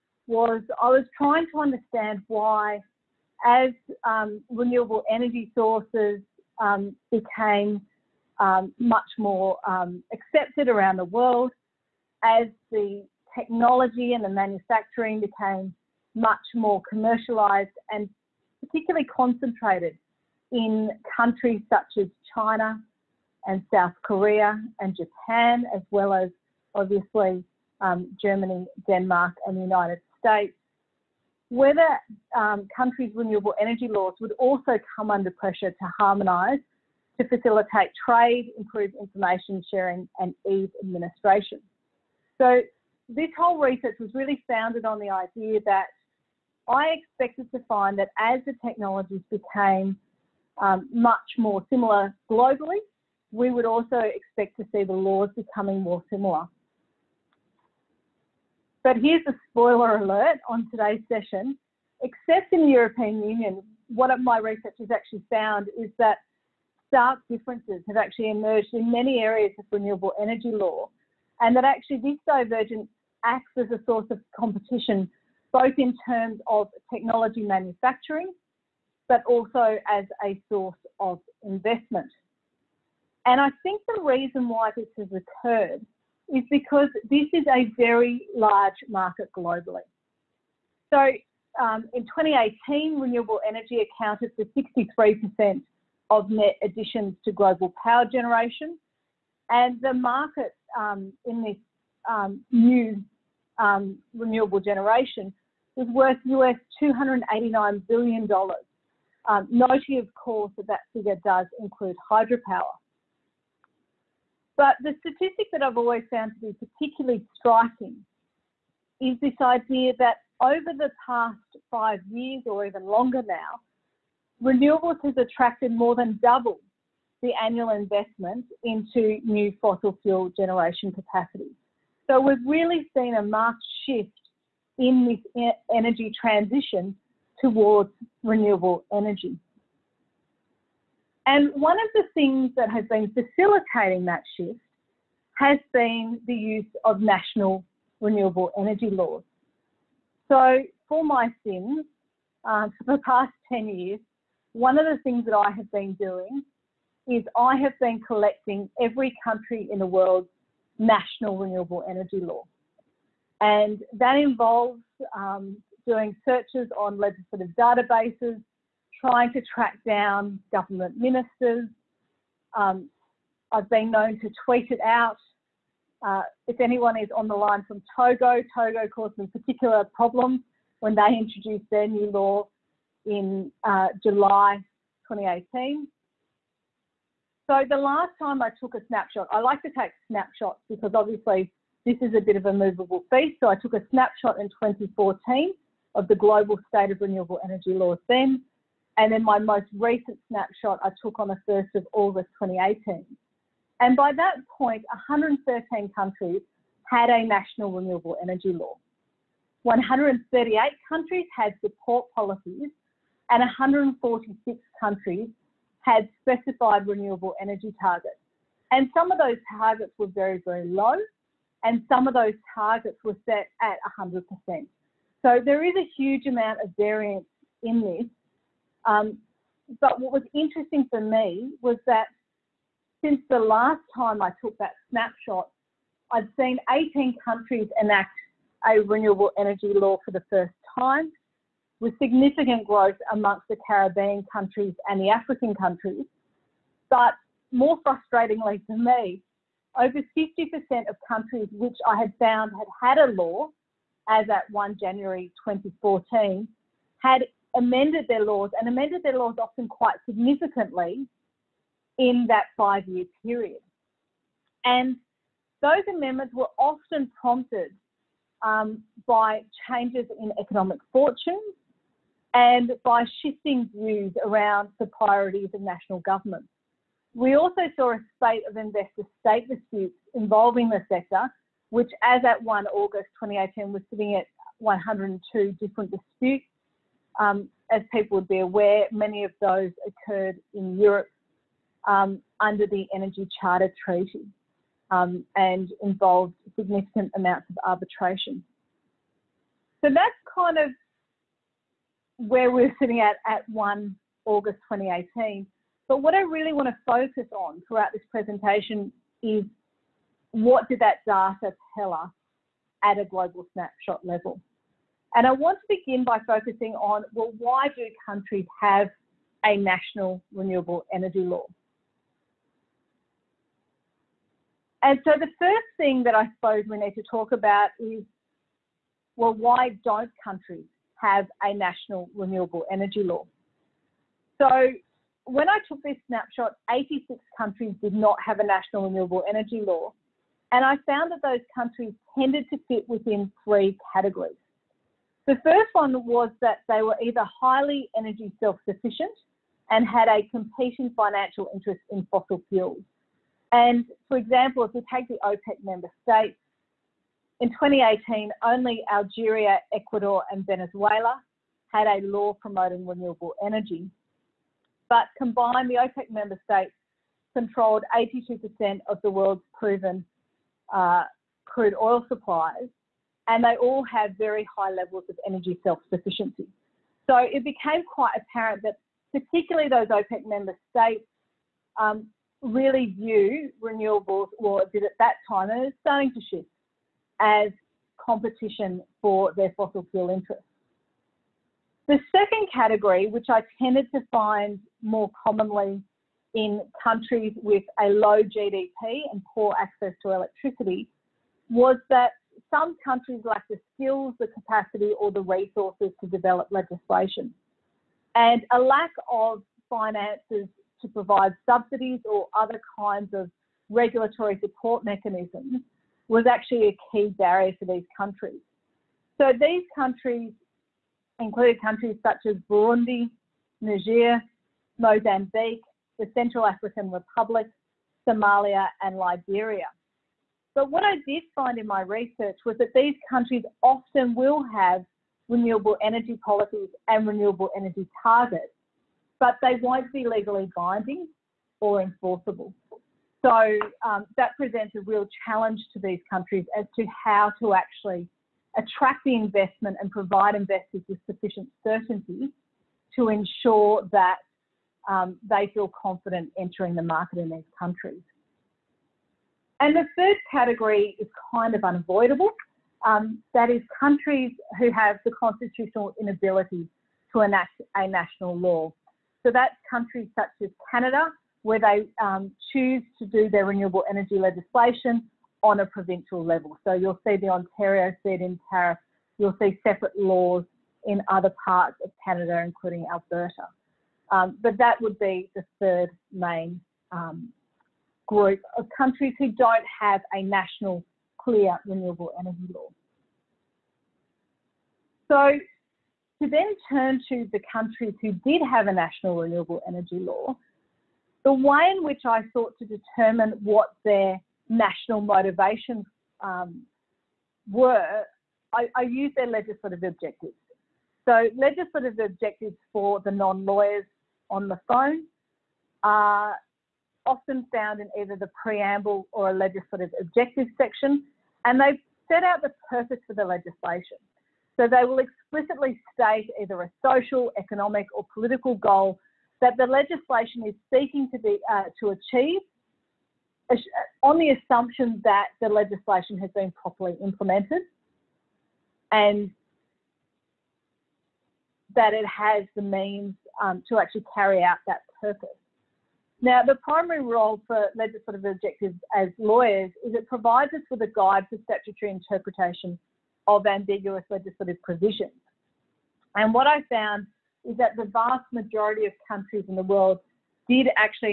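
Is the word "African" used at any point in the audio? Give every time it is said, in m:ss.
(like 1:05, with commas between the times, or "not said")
4:05, 7:06.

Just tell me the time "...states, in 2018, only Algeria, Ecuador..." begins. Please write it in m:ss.
5:56.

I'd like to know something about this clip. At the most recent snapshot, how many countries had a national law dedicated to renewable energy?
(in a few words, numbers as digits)
113.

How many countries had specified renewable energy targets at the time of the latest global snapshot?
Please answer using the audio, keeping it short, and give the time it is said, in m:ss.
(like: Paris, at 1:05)
146, at 3:33.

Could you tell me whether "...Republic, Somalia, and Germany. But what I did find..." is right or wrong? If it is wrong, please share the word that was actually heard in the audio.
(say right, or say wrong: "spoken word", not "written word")
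wrong: "Liberia", not "Germany".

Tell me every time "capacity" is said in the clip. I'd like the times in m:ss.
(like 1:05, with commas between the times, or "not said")
2:10, 6:44.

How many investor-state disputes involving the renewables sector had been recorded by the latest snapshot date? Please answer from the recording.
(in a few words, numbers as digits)
102.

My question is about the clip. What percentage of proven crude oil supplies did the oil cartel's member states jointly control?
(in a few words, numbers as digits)
82%.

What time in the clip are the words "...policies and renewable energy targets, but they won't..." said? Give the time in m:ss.
7:16.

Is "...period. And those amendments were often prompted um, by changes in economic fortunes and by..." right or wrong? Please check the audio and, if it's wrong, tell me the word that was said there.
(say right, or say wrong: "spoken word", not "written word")
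right.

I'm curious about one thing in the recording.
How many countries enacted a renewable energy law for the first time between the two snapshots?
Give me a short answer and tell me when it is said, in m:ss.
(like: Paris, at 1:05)
18, at 3:56.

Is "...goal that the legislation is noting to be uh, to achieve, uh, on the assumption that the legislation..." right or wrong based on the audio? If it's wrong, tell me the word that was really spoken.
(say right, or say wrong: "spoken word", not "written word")
wrong: "seeking", not "noting".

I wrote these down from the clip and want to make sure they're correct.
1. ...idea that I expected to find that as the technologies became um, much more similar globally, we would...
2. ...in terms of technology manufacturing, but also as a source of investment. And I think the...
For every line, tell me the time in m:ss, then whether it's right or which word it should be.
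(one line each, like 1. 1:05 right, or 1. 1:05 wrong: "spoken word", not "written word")
1. 0:45 right
2. 1:15 right.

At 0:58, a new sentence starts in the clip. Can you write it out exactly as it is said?
But here's a spoiler alert on today's session.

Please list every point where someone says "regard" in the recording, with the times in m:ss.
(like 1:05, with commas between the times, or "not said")
not said.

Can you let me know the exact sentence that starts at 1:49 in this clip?
Um, noting, of course, that that figure does include hydropower.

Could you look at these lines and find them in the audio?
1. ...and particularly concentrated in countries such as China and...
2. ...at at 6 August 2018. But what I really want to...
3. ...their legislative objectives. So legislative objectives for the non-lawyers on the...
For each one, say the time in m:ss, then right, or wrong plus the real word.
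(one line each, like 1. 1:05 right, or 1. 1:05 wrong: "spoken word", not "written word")
1. 0:17 right
2. 5:03 wrong: "1", not "6"
3. 8:29 right.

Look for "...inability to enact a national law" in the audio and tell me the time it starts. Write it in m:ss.
7:46.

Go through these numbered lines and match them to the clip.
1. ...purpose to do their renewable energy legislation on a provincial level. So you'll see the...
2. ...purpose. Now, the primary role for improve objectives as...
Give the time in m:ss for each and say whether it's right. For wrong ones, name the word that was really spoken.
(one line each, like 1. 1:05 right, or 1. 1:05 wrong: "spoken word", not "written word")
1. 7:52 wrong: "choose", not "purpose"
2. 9:05 wrong: "legislative", not "improve".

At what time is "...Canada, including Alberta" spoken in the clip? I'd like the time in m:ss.
8:02.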